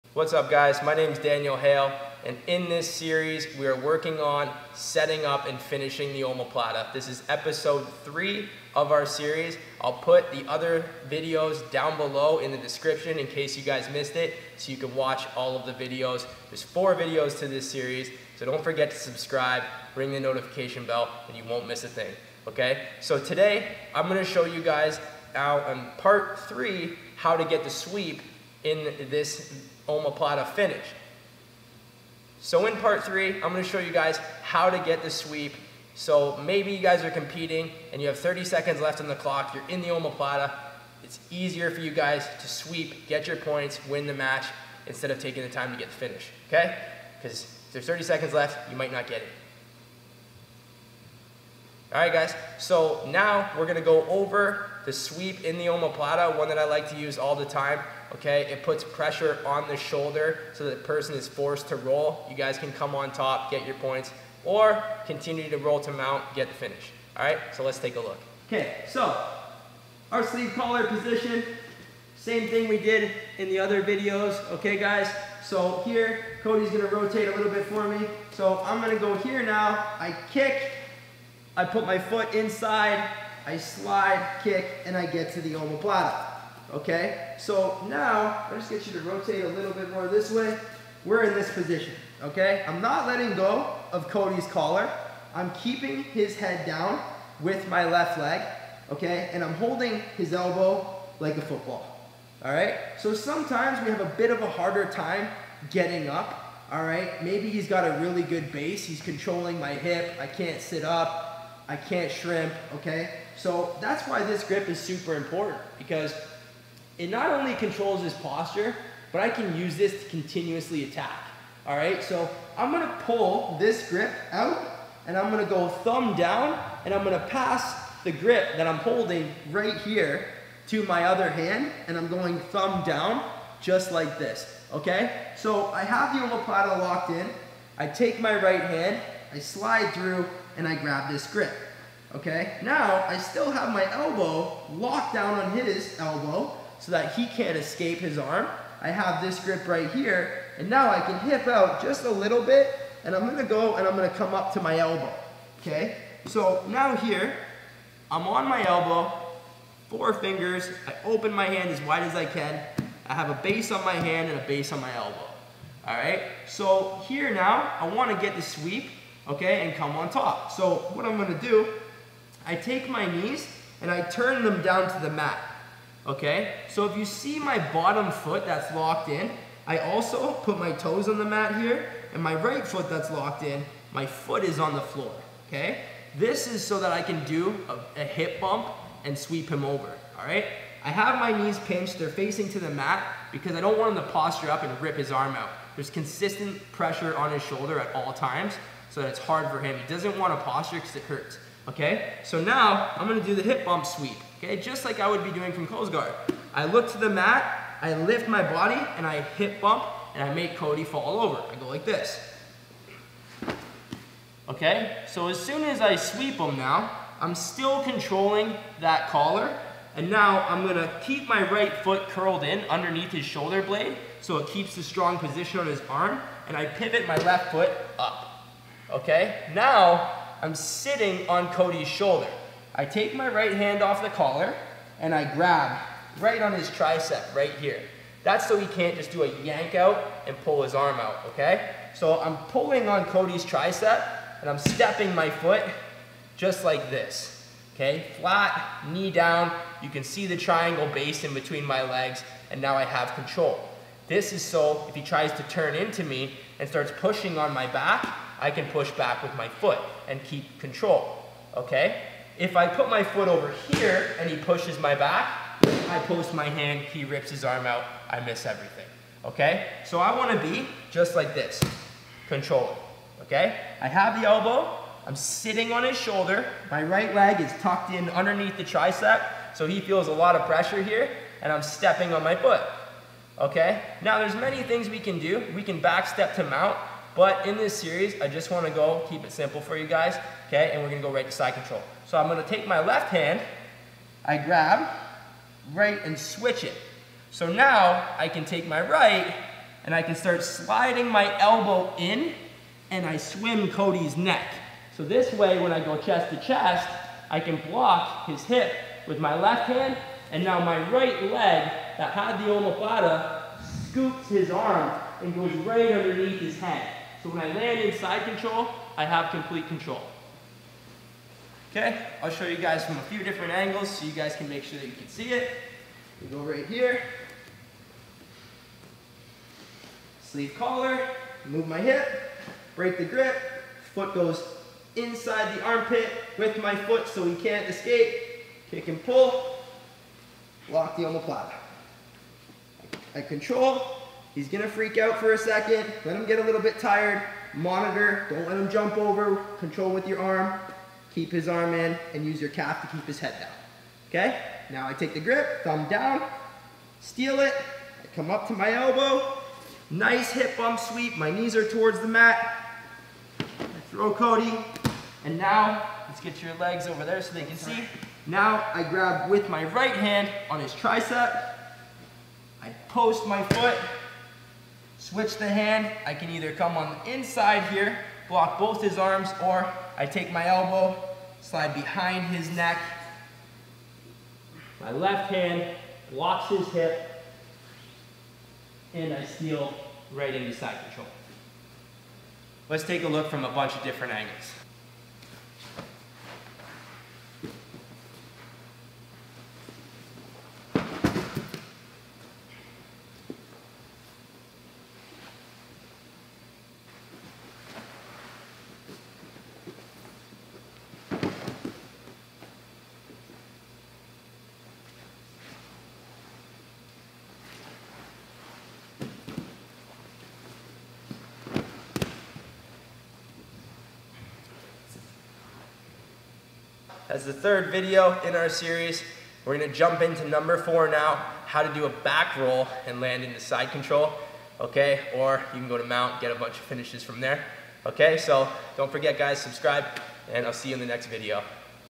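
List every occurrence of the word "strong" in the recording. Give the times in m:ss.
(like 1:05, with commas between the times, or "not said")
3:44.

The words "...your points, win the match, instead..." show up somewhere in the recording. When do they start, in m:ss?
0:43.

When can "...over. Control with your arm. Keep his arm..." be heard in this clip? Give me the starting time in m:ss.
5:48.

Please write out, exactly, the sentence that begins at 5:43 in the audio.
I control, He's gonna freak out for a second.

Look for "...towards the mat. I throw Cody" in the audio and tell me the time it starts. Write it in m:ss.
6:01.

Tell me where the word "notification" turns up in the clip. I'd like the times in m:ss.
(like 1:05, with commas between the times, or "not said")
0:20.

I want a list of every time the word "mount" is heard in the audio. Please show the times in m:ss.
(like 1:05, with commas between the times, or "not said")
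1:05, 4:46, 7:15.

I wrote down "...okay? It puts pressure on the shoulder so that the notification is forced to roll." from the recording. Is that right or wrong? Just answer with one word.
wrong.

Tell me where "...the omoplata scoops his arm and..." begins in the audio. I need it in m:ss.
5:12.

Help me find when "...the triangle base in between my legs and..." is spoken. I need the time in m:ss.
4:10.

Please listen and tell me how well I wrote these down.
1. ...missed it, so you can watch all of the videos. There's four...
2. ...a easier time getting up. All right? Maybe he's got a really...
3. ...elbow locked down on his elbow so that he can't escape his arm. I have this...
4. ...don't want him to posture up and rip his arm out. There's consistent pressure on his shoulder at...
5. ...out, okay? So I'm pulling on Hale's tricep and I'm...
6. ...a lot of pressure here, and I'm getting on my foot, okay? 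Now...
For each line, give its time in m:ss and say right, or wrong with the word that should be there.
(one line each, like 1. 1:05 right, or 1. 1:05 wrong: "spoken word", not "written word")
1. 0:13 right
2. 1:44 wrong: "harder", not "easier"
3. 2:23 right
4. 3:13 right
5. 4:00 wrong: "Cody", not "Hale"
6. 4:40 wrong: "stepping", not "getting".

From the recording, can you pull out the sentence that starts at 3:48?
Okay, now I'm sitting on Cody's shoulder.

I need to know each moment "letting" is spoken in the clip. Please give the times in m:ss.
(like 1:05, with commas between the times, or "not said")
1:33.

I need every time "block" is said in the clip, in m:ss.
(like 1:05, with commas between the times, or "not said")
5:07, 6:18, 6:26.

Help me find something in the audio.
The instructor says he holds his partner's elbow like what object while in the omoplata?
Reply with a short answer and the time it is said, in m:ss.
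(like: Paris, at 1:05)
a football, at 1:41.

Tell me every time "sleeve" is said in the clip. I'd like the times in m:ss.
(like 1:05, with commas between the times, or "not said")
1:10, 5:30.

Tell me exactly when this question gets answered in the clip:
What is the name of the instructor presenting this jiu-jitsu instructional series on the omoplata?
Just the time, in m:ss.
0:01.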